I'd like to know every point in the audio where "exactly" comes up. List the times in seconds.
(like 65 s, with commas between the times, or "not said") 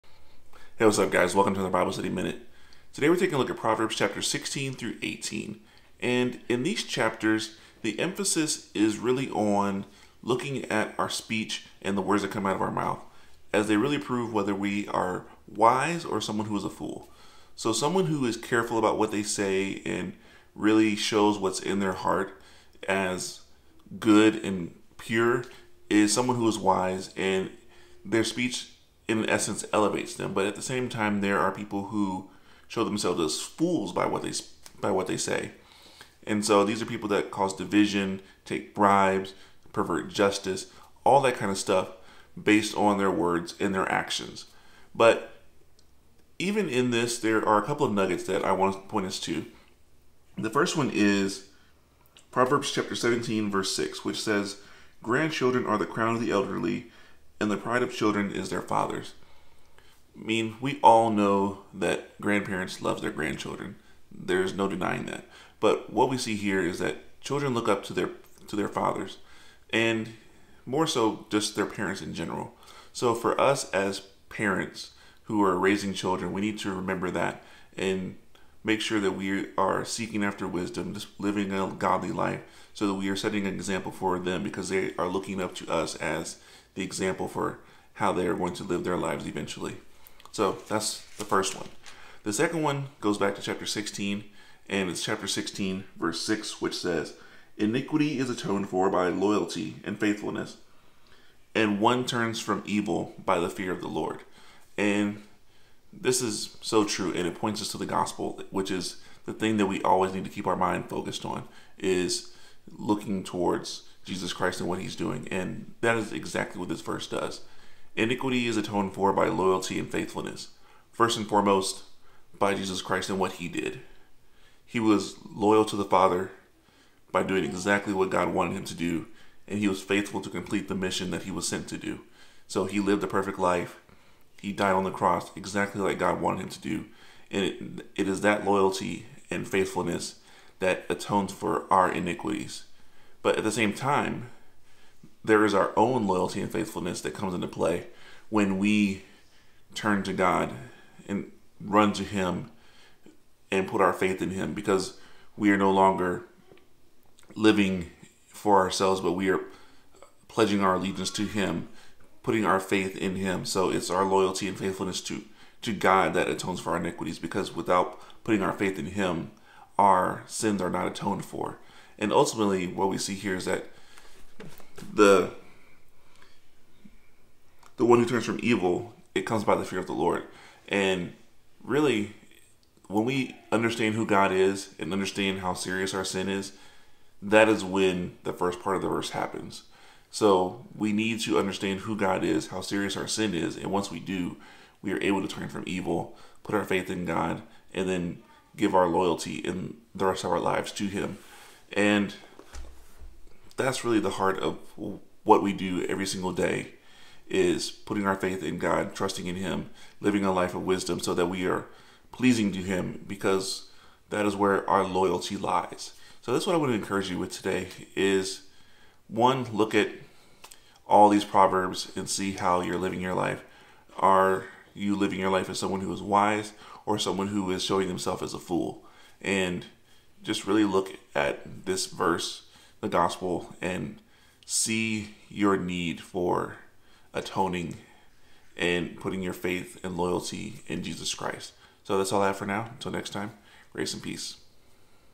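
116 s, 127 s, 135 s.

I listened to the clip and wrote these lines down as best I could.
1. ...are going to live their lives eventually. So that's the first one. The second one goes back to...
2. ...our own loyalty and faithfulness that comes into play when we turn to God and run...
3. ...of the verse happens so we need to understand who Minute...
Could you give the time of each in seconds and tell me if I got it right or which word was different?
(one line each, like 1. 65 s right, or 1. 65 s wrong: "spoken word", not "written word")
1. 88 s right
2. 145 s right
3. 188 s wrong: "God", not "Minute".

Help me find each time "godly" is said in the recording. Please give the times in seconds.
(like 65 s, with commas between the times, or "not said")
81 s.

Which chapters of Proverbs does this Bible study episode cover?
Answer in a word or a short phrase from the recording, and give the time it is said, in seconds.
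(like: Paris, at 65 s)
16 through 18, at 4 s.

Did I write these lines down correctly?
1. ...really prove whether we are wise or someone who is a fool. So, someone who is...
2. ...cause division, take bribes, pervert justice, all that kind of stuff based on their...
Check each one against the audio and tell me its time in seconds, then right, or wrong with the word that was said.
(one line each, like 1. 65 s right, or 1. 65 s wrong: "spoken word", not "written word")
1. 13 s right
2. 37 s right.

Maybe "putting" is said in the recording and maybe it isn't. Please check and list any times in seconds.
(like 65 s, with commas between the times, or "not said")
162 s, 168 s, 207 s, 238 s.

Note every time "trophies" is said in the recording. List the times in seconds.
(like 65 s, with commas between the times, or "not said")
not said.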